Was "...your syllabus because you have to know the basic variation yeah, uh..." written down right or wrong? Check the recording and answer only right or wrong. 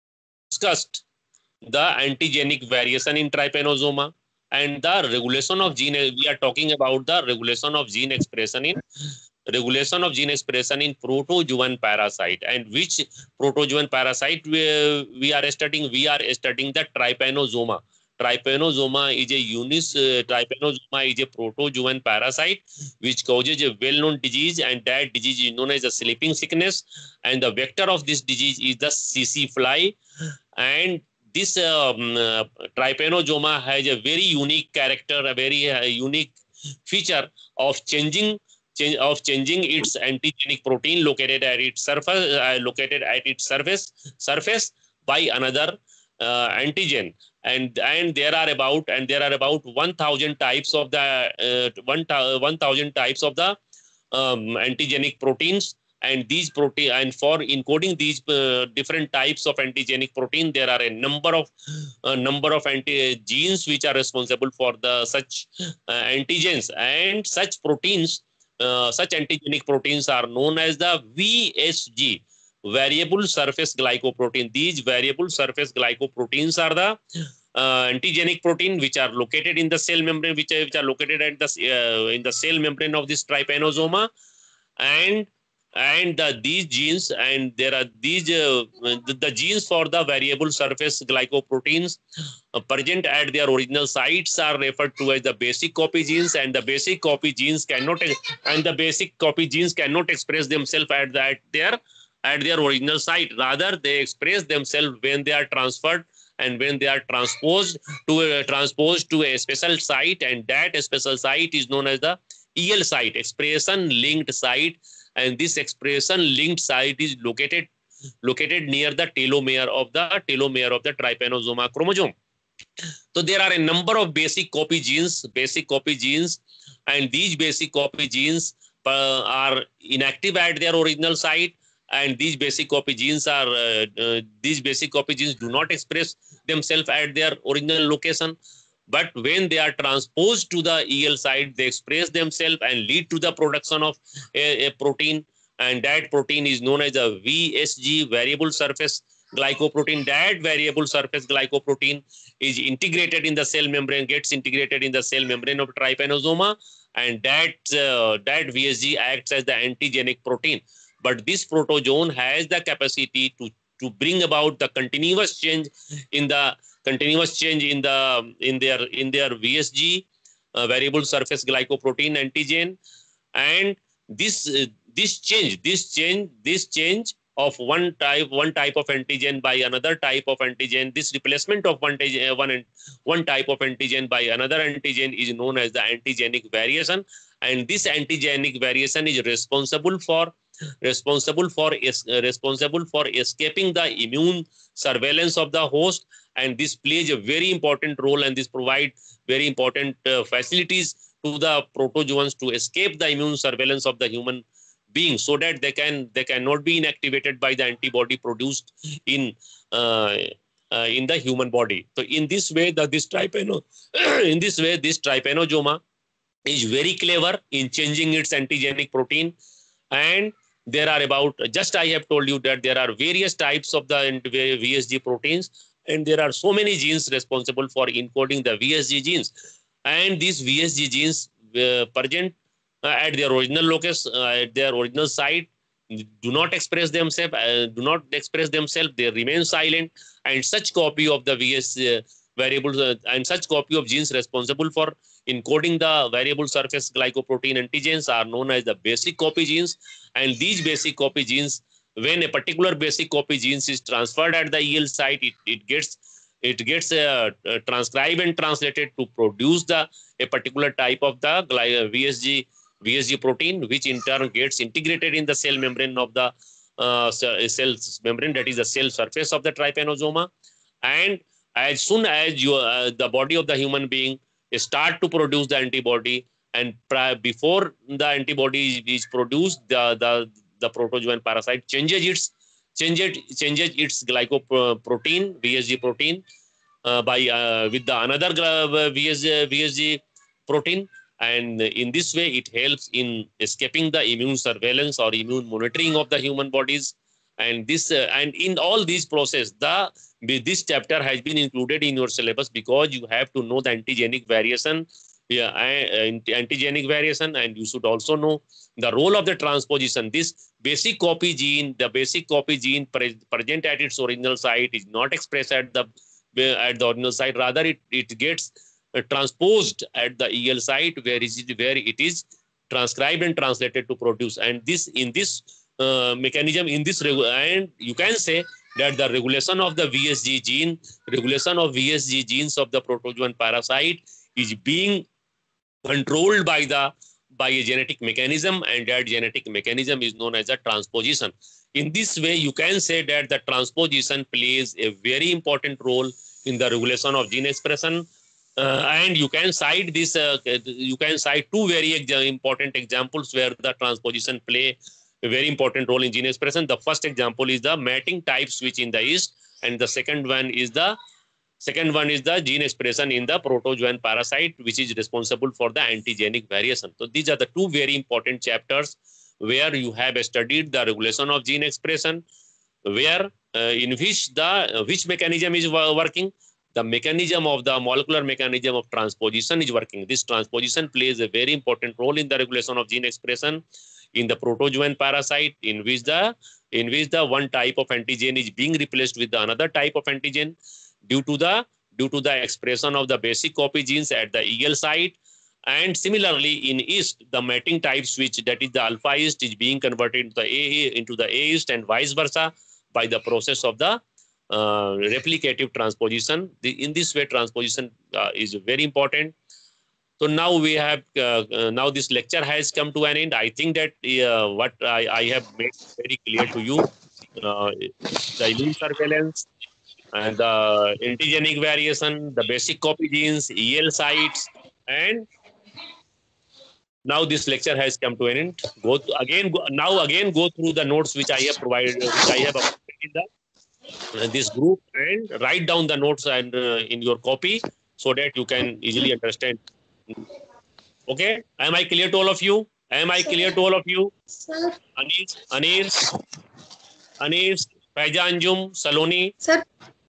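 wrong.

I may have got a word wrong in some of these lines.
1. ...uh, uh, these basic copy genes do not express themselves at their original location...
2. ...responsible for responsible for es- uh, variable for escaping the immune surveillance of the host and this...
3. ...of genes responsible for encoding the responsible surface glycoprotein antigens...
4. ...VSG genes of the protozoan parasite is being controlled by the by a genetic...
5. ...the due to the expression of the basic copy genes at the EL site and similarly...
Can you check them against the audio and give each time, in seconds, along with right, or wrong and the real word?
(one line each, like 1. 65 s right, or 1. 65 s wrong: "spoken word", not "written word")
1. 133 s right
2. 189 s wrong: "responsible", not "variable"
3. 243 s wrong: "variable", not "responsible"
4. 331 s right
5. 391 s right.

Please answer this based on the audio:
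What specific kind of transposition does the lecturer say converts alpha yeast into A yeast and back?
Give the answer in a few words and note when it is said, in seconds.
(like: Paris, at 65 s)
replicative transposition, at 405 s.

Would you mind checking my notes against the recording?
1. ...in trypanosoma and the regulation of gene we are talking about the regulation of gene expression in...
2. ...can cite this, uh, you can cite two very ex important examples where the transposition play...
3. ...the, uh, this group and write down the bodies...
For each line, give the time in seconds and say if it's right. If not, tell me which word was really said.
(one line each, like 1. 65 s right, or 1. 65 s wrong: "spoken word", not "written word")
1. 3 s right
2. 349 s right
3. 433 s wrong: "notes", not "bodies".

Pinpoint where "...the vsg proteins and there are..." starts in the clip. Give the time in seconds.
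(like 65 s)
223 s.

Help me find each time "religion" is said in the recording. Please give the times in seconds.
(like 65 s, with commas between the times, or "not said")
not said.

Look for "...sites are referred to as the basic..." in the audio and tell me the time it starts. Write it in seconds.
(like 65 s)
93 s.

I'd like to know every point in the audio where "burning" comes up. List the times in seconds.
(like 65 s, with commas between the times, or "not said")
not said.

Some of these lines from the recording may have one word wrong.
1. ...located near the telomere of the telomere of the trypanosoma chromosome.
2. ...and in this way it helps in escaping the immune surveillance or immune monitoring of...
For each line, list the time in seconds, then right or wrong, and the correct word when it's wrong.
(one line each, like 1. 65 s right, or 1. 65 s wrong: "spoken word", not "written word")
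1. 118 s right
2. 291 s right.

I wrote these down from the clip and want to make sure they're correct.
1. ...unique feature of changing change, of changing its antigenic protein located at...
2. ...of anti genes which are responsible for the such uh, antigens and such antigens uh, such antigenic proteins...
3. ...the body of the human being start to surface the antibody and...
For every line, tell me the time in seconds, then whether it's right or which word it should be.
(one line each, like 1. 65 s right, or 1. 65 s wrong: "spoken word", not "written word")
1. 35 s right
2. 62 s wrong: "proteins", not "antigens"
3. 272 s wrong: "produce", not "surface".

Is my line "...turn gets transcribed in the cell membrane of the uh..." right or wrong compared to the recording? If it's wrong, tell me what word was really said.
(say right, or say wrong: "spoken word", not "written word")
wrong: "integrated", not "transcribed".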